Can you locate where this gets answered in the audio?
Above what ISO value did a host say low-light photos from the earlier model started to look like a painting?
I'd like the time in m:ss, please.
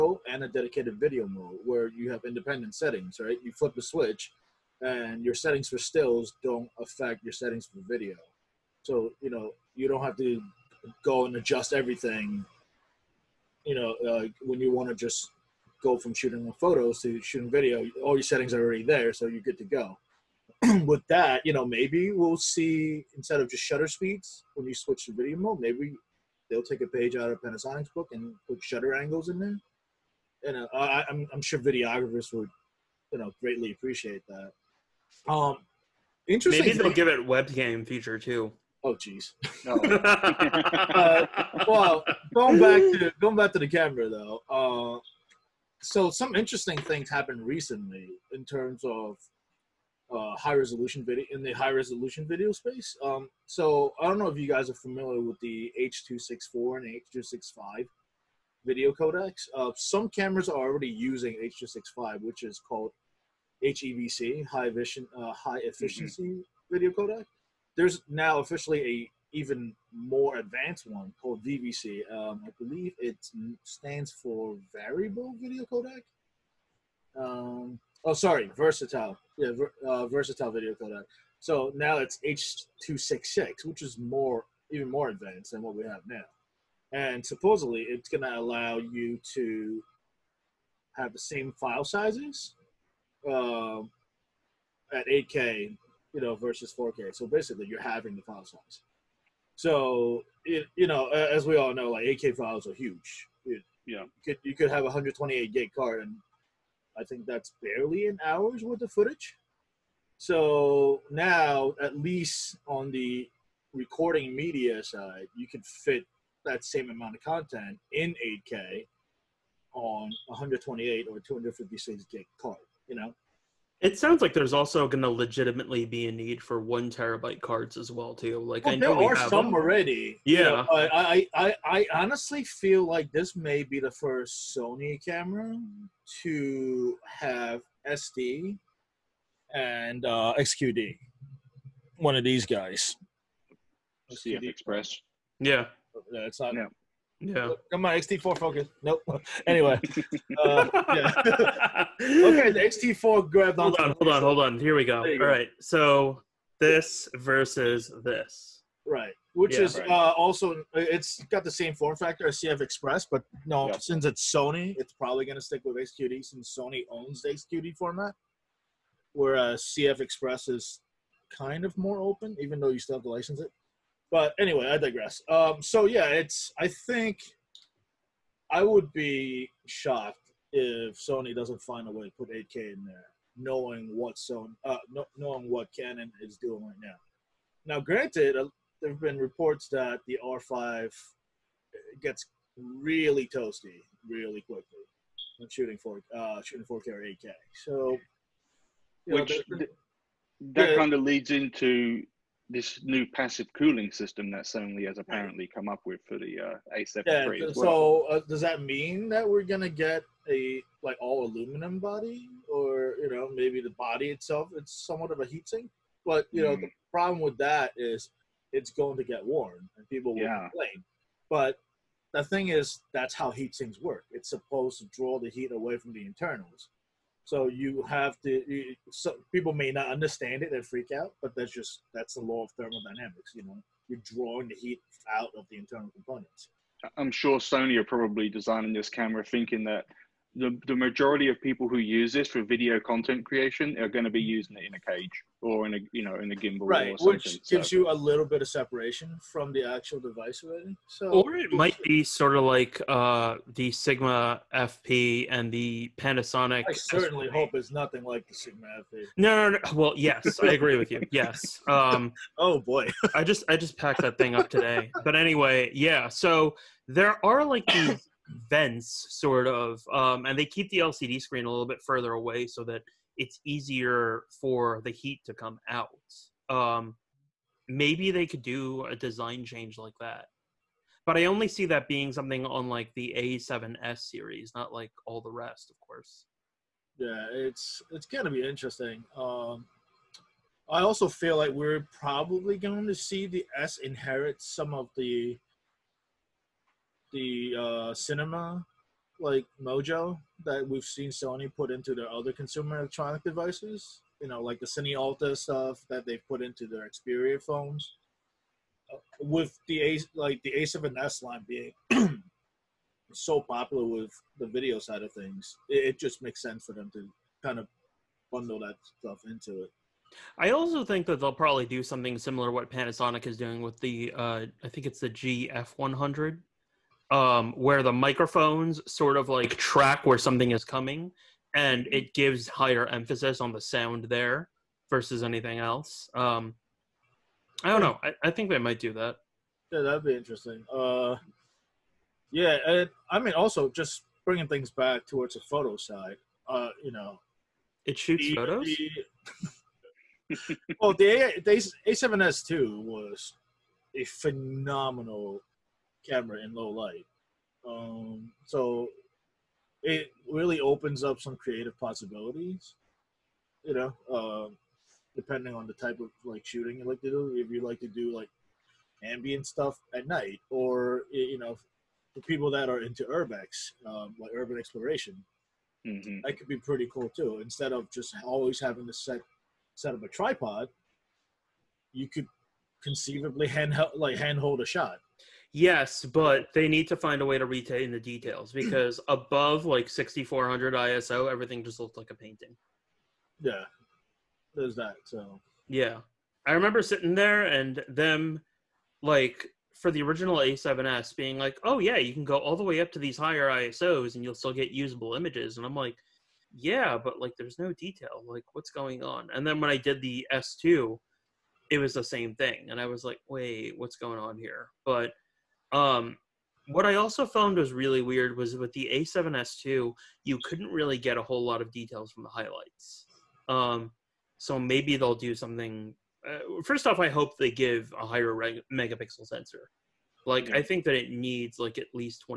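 6:29.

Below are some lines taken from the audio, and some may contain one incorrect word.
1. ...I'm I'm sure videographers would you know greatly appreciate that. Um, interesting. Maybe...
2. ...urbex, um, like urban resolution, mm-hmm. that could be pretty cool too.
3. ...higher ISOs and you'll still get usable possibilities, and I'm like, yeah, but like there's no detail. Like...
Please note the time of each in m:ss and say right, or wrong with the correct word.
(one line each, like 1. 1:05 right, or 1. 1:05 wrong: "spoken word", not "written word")
1. 0:31 right
2. 6:13 wrong: "exploration", not "resolution"
3. 6:43 wrong: "images", not "possibilities".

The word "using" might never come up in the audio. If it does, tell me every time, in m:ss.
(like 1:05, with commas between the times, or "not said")
1:00, 4:04.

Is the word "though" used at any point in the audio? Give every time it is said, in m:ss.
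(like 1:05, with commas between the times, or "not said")
0:44, 2:52.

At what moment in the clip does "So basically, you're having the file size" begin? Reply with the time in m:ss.
1:37.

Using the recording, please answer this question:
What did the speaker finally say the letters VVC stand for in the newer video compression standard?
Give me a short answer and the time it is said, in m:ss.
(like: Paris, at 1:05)
Versatile video codec, at 1:20.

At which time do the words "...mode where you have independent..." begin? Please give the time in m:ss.
0:01.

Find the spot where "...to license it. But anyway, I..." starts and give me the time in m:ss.
2:53.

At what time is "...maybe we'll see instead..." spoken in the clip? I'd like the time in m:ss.
0:21.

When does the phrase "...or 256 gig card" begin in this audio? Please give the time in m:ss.
2:01.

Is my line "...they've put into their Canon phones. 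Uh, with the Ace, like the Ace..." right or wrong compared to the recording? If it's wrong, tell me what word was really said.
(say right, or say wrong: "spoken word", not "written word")
wrong: "Xperia", not "Canon".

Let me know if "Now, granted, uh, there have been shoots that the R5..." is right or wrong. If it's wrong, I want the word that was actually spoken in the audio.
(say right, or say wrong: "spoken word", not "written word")
wrong: "reports", not "shoots".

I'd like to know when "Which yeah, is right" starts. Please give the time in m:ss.
2:39.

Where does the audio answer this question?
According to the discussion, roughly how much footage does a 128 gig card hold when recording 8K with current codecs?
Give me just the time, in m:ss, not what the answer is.
1:48.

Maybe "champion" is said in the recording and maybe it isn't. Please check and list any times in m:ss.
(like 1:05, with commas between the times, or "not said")
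not said.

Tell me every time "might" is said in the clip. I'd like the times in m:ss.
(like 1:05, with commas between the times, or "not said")
4:11, 5:38.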